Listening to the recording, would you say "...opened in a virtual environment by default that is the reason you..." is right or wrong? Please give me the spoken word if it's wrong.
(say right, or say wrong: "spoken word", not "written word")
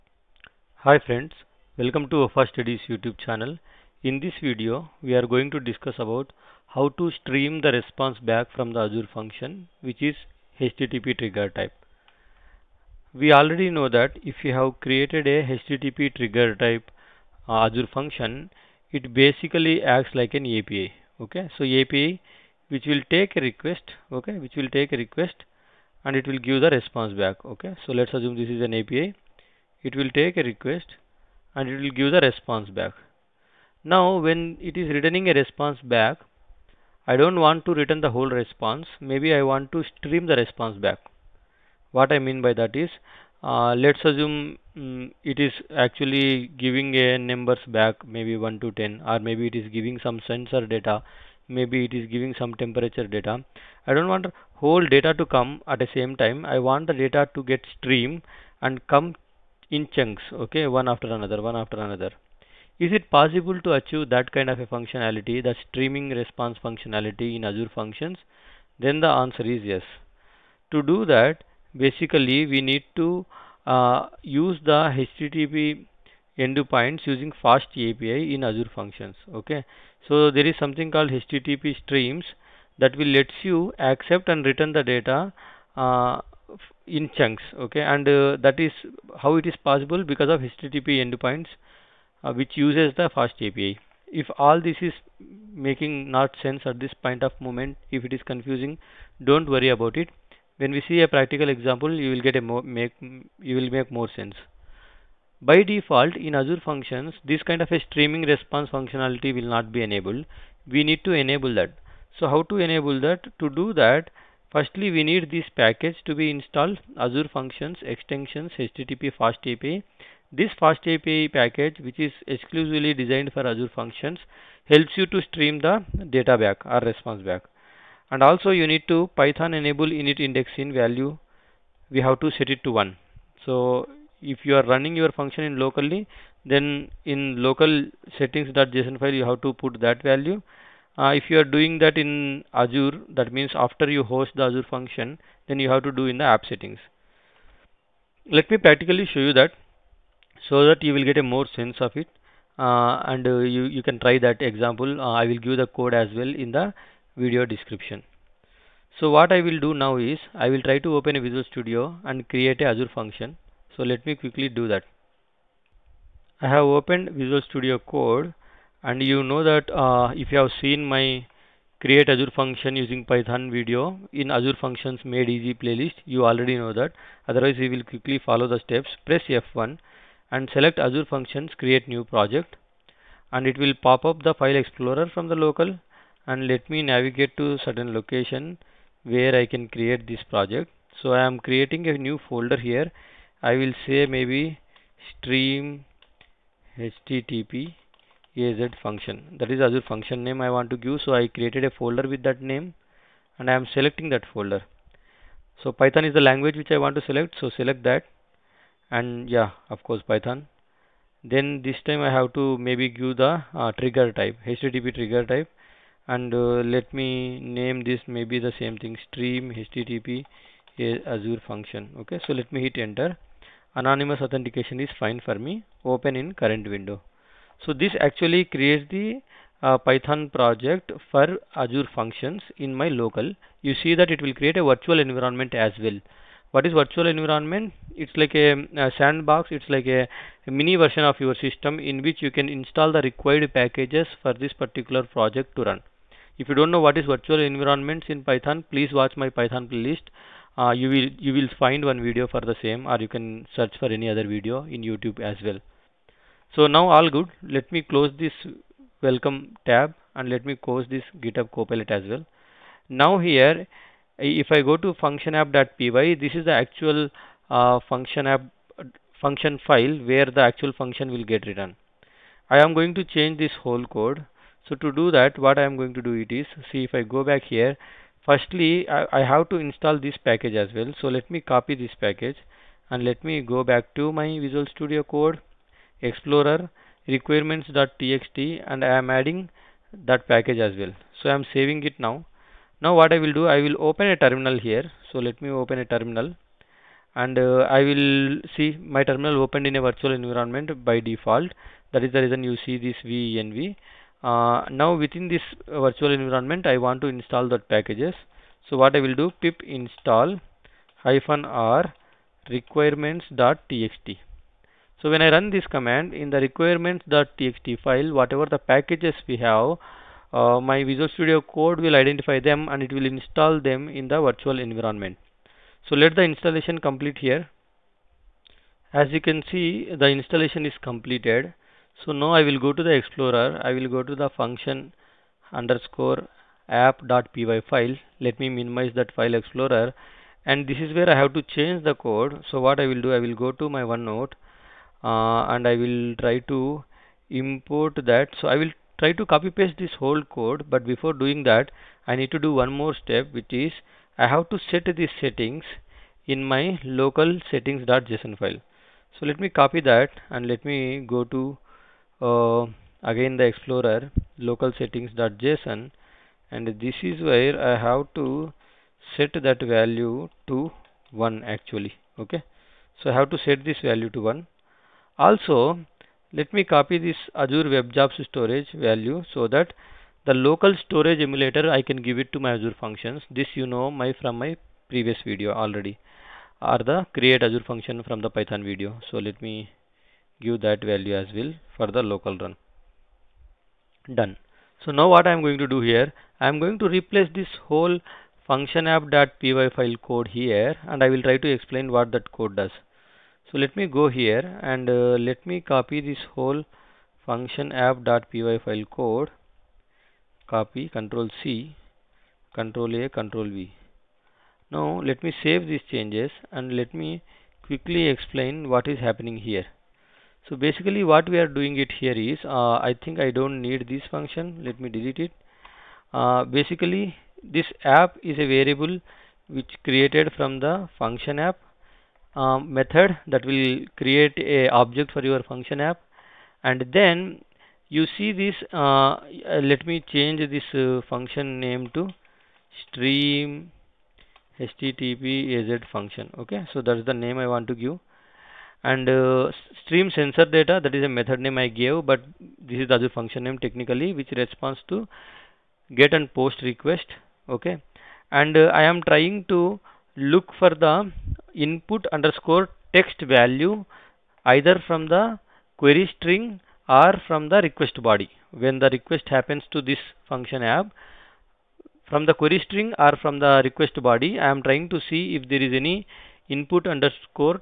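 right.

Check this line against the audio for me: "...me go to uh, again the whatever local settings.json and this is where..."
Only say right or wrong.
wrong.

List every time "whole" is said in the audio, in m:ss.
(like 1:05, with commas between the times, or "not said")
0:38, 0:54, 4:33, 5:49, 6:37, 6:46.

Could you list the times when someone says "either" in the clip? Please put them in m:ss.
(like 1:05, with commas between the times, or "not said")
7:44.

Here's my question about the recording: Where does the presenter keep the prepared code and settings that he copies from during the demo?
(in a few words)
OneNote.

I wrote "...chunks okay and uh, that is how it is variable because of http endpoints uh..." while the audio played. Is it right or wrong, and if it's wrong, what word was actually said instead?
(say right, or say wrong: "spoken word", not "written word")
wrong: "possible", not "variable".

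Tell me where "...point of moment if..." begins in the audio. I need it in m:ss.
1:37.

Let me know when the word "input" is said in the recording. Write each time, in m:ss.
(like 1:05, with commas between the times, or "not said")
7:41, 7:56.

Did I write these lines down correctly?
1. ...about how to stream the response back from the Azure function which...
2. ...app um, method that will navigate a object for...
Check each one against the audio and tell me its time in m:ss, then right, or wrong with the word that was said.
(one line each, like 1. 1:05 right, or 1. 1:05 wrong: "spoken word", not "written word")
1. 0:05 right
2. 7:11 wrong: "create", not "navigate".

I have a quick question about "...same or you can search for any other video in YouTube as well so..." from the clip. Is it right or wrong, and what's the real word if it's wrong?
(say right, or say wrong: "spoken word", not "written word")
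right.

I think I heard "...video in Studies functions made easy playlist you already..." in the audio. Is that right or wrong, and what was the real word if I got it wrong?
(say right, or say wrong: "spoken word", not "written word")
wrong: "Azure", not "Studies".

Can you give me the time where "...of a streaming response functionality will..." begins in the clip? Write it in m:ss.
1:47.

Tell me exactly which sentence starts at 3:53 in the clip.
You see that it will create a virtual environment as well.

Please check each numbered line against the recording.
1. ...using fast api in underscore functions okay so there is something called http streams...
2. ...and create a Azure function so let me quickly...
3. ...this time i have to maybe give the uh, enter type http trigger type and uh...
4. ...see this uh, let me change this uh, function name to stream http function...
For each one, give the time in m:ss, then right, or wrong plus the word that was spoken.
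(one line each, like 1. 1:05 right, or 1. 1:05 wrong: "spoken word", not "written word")
1. 1:17 wrong: "azure", not "underscore"
2. 2:42 right
3. 3:31 wrong: "trigger", not "enter"
4. 7:18 right.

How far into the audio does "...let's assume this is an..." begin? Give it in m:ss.
0:27.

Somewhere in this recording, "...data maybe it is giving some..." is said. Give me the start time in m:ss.
0:50.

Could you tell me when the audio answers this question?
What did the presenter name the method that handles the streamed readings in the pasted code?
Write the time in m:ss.
7:29.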